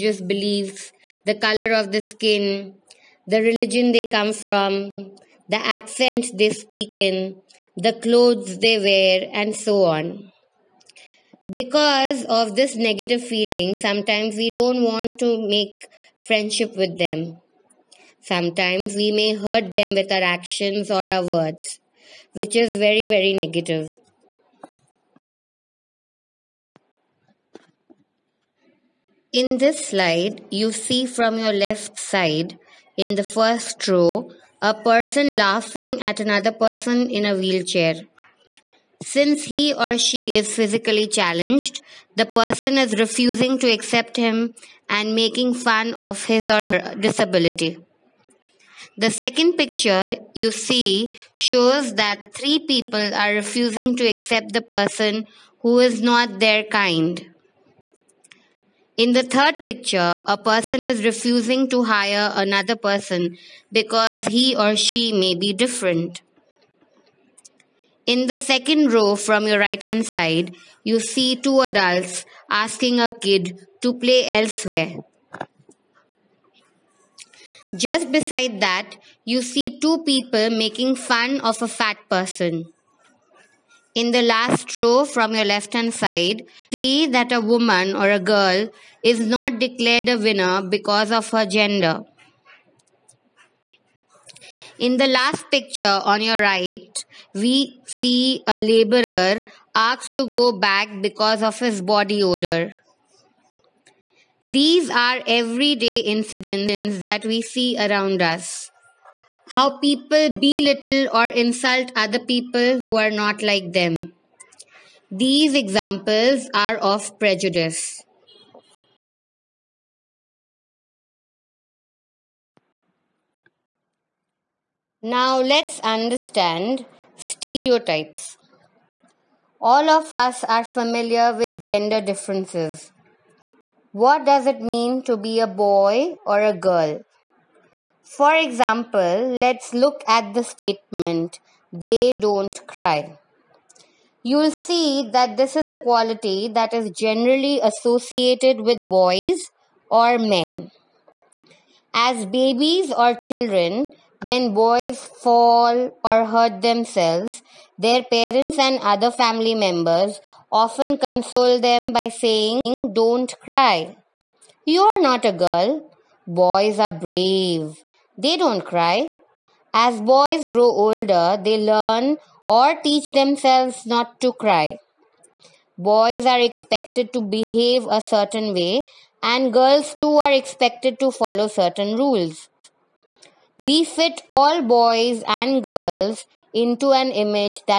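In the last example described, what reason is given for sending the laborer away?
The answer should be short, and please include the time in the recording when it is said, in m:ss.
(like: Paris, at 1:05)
body odor, at 1:41.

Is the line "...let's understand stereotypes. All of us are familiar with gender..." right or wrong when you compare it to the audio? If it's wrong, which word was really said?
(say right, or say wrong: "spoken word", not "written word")
right.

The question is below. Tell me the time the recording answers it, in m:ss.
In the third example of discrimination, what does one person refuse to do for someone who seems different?
1:01.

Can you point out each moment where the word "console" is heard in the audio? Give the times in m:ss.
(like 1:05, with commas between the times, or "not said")
2:40.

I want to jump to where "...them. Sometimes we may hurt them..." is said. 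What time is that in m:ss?
0:16.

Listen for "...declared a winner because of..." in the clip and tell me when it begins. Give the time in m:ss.
1:29.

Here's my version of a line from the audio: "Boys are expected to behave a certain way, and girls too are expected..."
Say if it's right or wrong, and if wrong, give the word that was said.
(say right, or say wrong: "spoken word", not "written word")
right.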